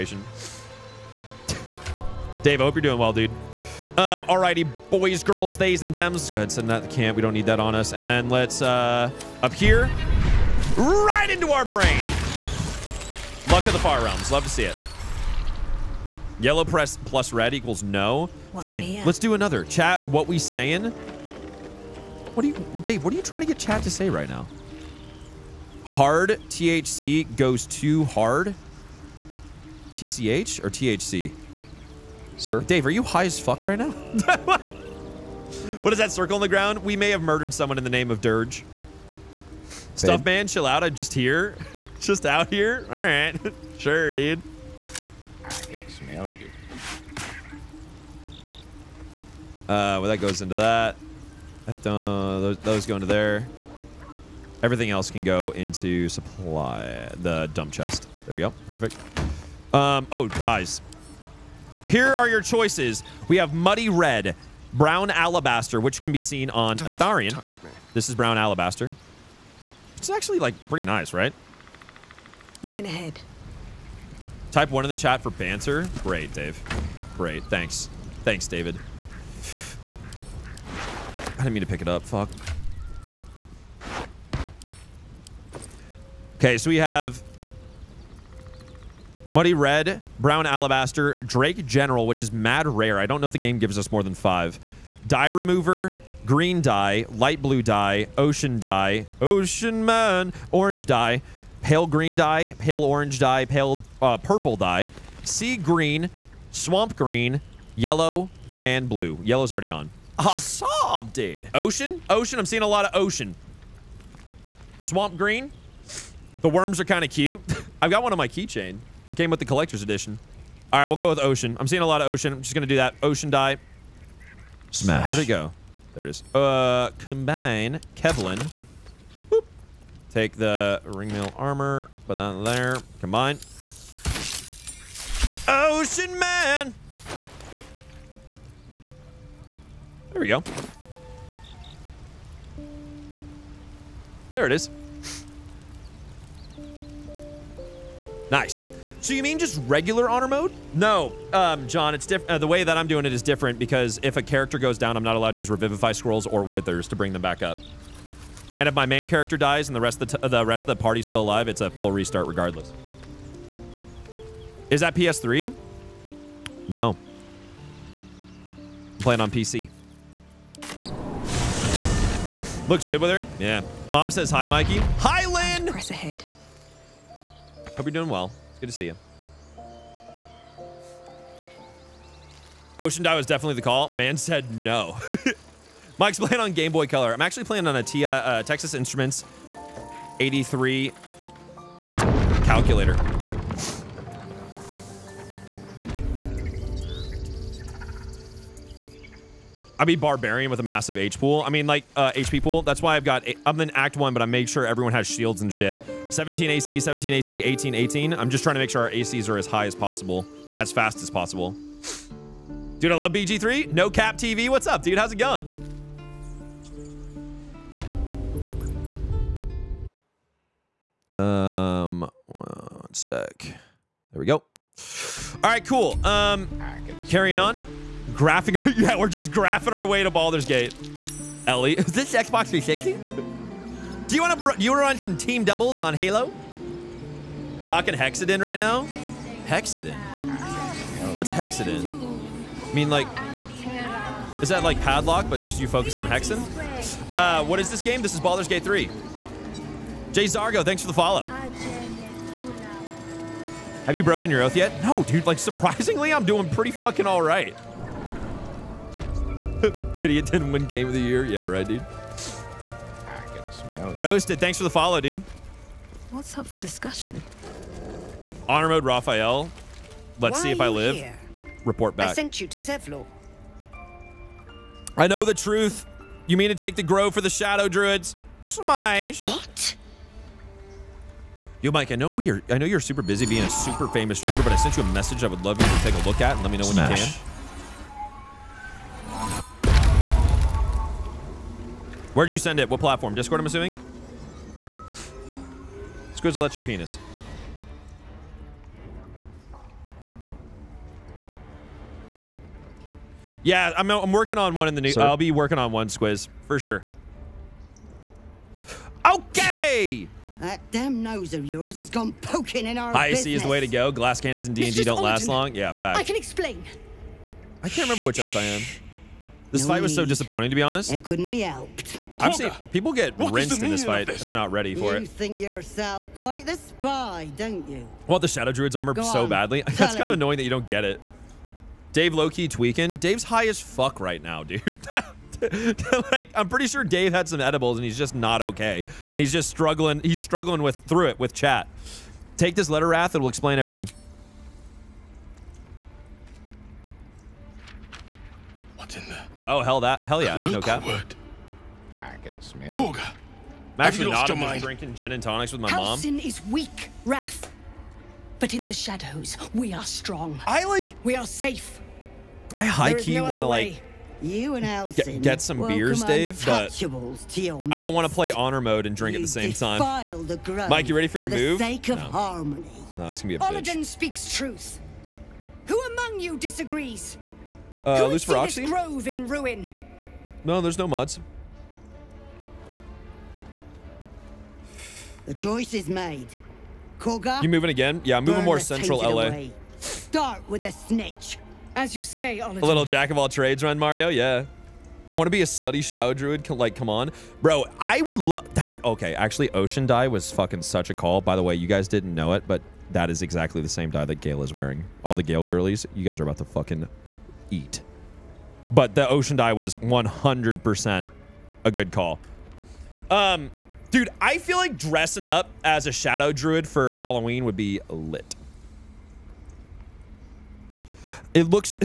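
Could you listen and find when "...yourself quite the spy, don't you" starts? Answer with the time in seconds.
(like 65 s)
325 s.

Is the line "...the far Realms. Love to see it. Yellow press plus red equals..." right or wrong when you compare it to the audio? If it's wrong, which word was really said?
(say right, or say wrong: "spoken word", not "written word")
right.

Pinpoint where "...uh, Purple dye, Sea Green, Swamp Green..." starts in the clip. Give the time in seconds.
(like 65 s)
104 s.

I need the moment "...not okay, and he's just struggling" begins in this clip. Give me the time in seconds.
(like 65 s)
338 s.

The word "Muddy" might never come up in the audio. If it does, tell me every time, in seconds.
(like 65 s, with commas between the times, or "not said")
63 s, 89 s.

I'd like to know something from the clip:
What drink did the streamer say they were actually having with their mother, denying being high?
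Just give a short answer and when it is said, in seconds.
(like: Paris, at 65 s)
gin and tonics, at 354 s.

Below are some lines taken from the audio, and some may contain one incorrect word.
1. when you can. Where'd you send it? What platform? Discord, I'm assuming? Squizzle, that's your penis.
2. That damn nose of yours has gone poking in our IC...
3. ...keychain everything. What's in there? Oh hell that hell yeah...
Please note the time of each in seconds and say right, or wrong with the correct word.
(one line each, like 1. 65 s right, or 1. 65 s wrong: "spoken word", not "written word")
1. 286 s right
2. 310 s right
3. 343 s wrong: "explain", not "keychain".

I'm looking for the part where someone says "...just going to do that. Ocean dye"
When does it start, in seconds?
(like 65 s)
122 s.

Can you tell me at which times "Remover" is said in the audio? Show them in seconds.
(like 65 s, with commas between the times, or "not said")
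95 s.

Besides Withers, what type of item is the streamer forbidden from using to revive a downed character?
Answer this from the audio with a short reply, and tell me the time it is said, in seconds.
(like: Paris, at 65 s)
Revivify Scrolls, at 155 s.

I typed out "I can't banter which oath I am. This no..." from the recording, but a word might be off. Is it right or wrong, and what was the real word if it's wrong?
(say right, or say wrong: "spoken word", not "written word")
wrong: "remember", not "banter".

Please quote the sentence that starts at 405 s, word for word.
All the Gale girlies, you guys are about to fucking eat.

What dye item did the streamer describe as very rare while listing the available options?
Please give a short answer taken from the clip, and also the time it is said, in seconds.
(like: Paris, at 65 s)
Drake General, at 91 s.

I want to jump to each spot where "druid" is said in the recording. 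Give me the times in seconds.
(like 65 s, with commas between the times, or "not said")
277 s, 328 s, 396 s, 416 s.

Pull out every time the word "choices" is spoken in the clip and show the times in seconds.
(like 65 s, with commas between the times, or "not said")
62 s, 385 s.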